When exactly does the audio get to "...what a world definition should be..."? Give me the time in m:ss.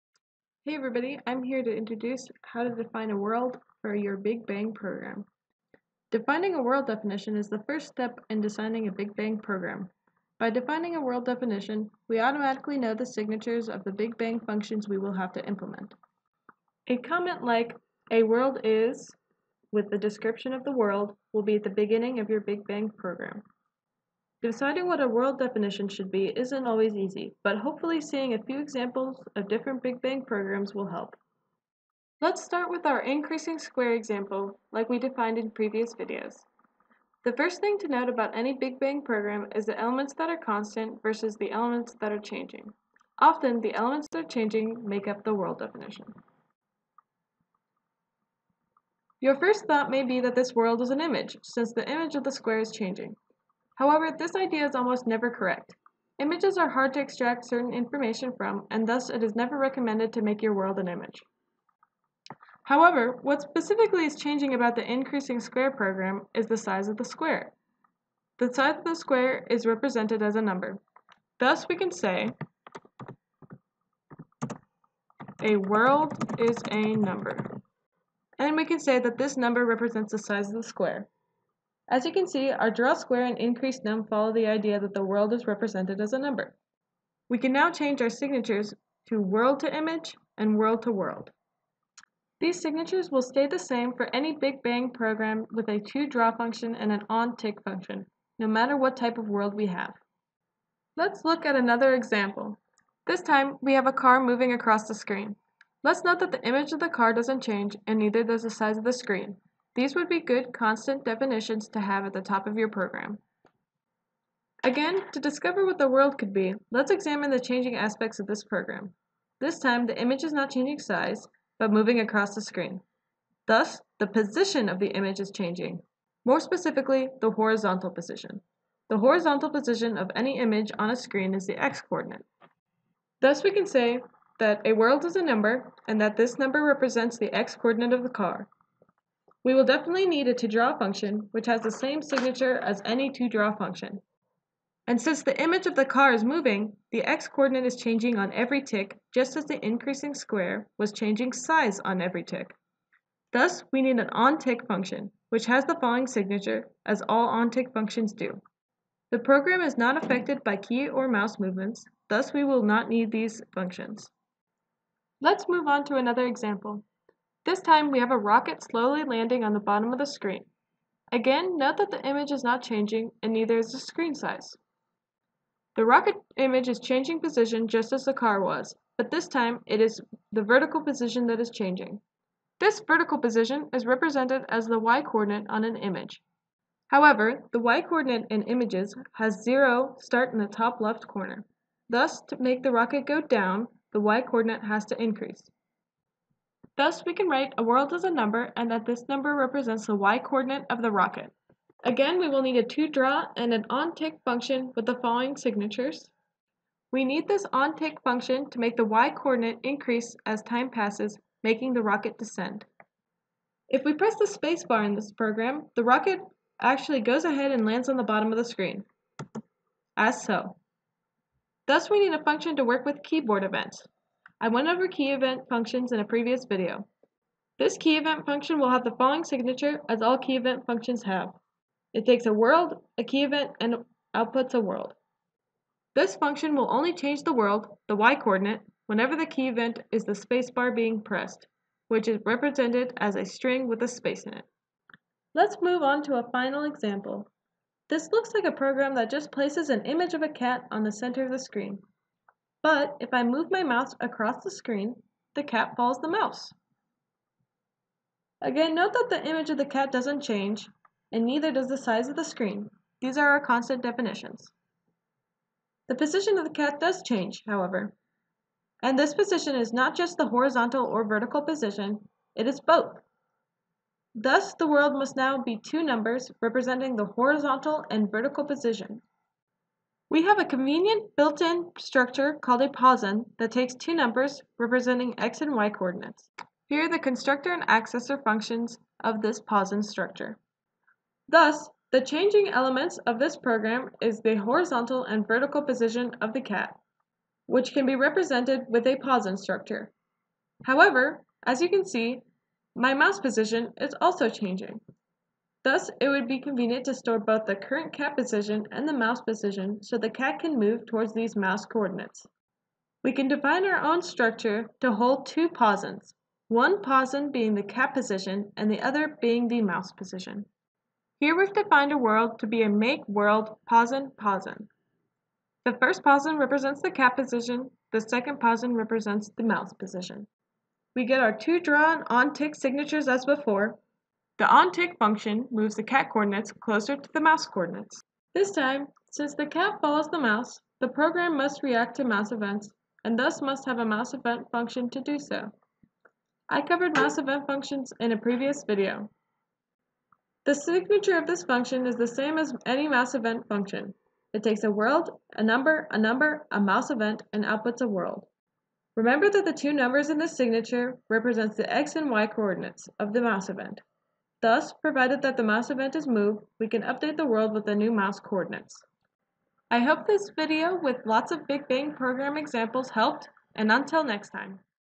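0:24.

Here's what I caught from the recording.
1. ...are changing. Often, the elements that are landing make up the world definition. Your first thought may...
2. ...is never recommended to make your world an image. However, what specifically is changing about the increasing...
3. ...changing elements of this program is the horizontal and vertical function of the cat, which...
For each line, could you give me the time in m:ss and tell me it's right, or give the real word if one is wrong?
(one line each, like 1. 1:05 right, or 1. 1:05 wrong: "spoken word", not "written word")
1. 0:42 wrong: "changing", not "landing"
2. 0:59 right
3. 4:52 wrong: "position", not "function".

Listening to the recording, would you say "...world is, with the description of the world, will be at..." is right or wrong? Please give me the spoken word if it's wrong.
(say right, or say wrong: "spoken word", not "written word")
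right.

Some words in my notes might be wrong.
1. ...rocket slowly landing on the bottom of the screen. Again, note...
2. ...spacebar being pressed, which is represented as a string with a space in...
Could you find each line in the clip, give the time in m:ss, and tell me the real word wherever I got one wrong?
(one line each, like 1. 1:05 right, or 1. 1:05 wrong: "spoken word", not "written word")
1. 2:48 right
2. 4:00 right.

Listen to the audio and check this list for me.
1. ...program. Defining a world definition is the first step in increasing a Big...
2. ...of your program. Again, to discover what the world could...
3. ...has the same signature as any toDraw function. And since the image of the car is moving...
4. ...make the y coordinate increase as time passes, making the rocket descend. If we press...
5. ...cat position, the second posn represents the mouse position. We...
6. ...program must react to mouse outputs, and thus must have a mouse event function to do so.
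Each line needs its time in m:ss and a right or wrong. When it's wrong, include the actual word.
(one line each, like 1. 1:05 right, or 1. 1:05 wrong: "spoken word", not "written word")
1. 0:04 wrong: "designing", not "increasing"
2. 1:52 right
3. 2:21 right
4. 3:28 right
5. 5:26 right
6. 5:40 wrong: "events", not "outputs".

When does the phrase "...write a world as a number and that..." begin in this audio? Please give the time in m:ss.
3:17.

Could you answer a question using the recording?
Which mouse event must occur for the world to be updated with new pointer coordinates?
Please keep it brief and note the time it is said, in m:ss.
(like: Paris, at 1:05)
moved, at 6:06.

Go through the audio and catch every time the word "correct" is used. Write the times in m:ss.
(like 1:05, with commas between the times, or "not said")
0:55.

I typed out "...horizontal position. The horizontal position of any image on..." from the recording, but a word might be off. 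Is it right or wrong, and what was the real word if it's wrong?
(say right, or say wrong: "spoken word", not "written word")
right.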